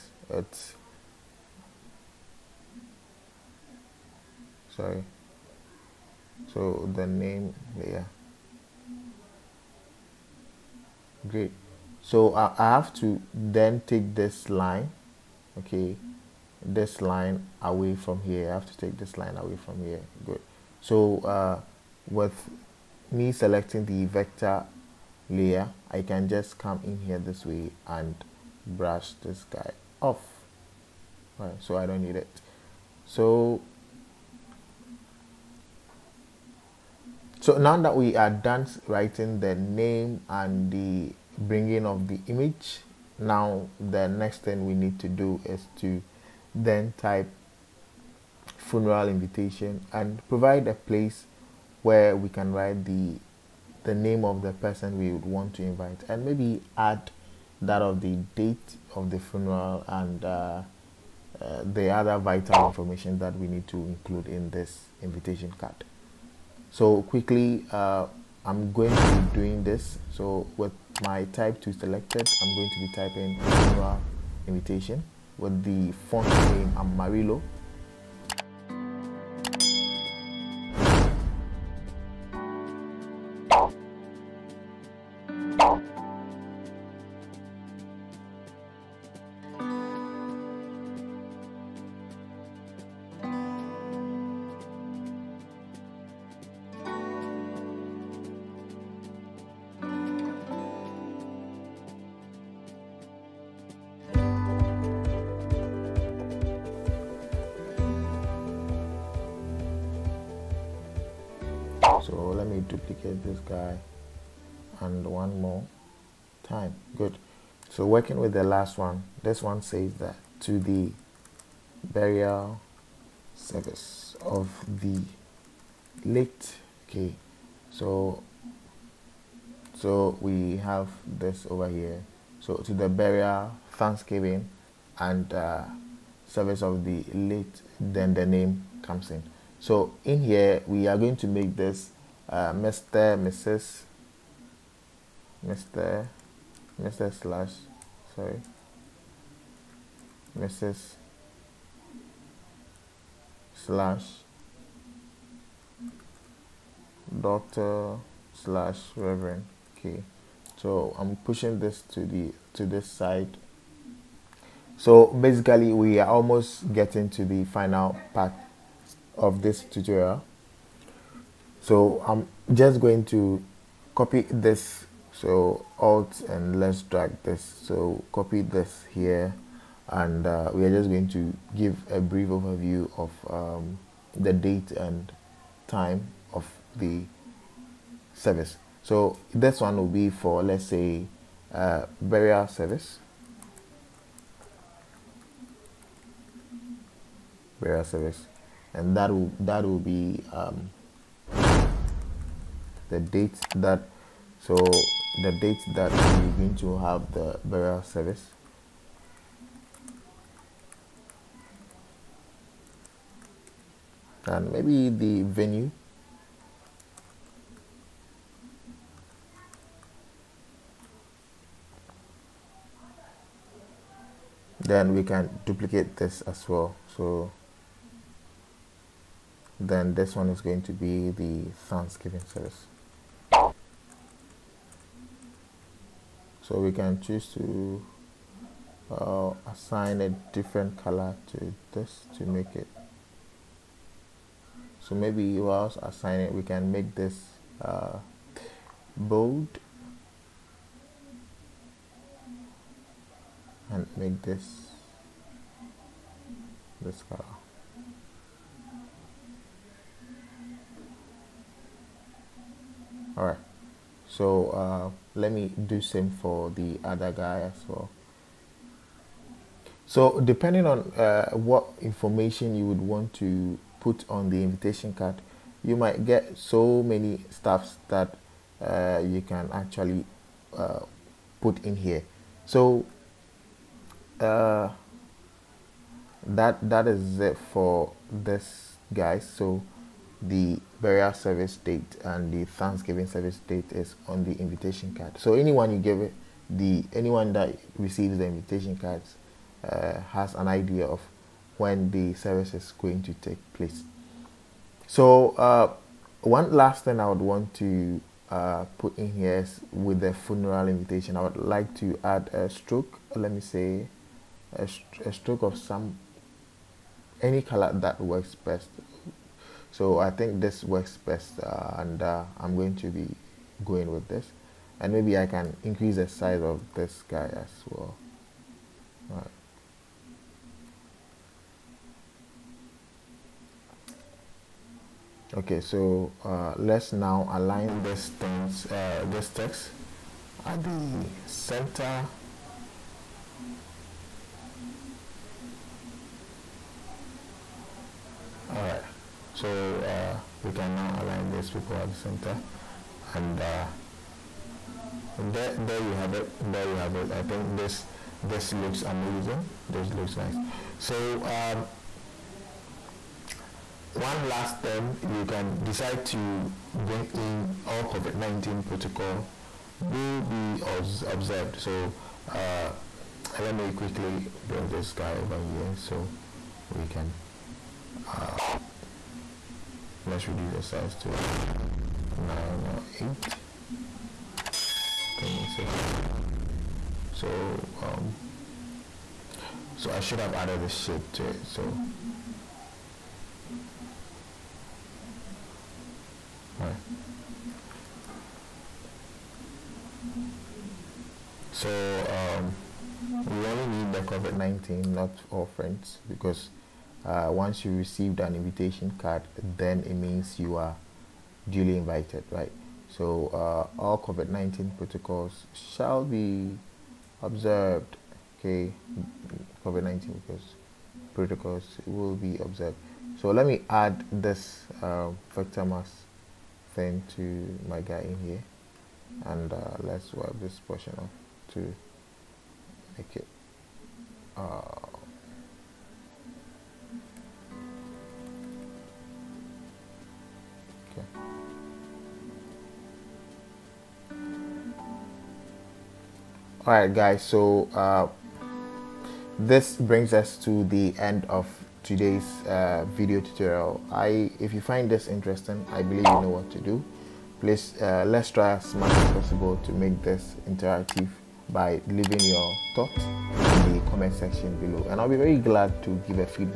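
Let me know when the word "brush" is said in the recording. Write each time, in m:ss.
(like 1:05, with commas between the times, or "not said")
0:28.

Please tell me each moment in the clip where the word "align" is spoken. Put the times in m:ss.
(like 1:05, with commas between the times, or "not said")
5:37, 5:51.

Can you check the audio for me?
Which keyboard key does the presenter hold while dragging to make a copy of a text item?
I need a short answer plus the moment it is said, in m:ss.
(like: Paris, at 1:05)
Alt, at 2:55.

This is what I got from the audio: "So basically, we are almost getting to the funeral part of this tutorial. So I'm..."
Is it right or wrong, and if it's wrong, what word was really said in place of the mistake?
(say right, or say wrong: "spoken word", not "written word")
wrong: "final", not "funeral".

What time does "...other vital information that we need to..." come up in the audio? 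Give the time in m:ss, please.
1:01.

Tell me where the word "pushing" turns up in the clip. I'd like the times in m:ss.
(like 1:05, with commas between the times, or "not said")
2:41.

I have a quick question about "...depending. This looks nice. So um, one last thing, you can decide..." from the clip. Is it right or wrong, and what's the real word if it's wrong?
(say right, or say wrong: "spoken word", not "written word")
wrong: "amazing", not "depending".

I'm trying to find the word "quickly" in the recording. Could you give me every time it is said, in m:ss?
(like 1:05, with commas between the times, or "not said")
1:07, 6:13.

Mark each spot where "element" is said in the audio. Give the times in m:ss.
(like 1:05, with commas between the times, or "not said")
not said.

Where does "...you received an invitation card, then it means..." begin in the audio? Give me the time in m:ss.
6:47.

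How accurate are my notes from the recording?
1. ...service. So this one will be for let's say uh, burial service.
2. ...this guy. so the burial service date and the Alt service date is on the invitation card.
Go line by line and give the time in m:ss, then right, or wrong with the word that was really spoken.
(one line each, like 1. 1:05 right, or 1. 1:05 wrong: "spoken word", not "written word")
1. 3:08 right
2. 4:48 wrong: "Thanksgiving", not "Alt".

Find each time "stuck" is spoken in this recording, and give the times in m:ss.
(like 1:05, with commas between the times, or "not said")
not said.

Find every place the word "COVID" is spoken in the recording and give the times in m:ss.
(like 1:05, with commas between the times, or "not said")
6:07, 6:44, 6:53, 6:59.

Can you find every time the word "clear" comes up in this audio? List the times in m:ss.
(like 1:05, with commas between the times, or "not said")
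not said.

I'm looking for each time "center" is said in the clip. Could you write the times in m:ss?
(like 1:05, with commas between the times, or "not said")
5:41, 5:51.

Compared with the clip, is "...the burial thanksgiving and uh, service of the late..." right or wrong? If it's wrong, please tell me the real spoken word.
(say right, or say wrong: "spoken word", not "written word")
right.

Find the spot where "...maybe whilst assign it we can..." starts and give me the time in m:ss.
4:04.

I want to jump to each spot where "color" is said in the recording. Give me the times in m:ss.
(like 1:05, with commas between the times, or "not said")
4:00, 4:17, 5:17.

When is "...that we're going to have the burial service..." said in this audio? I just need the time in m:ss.
3:25.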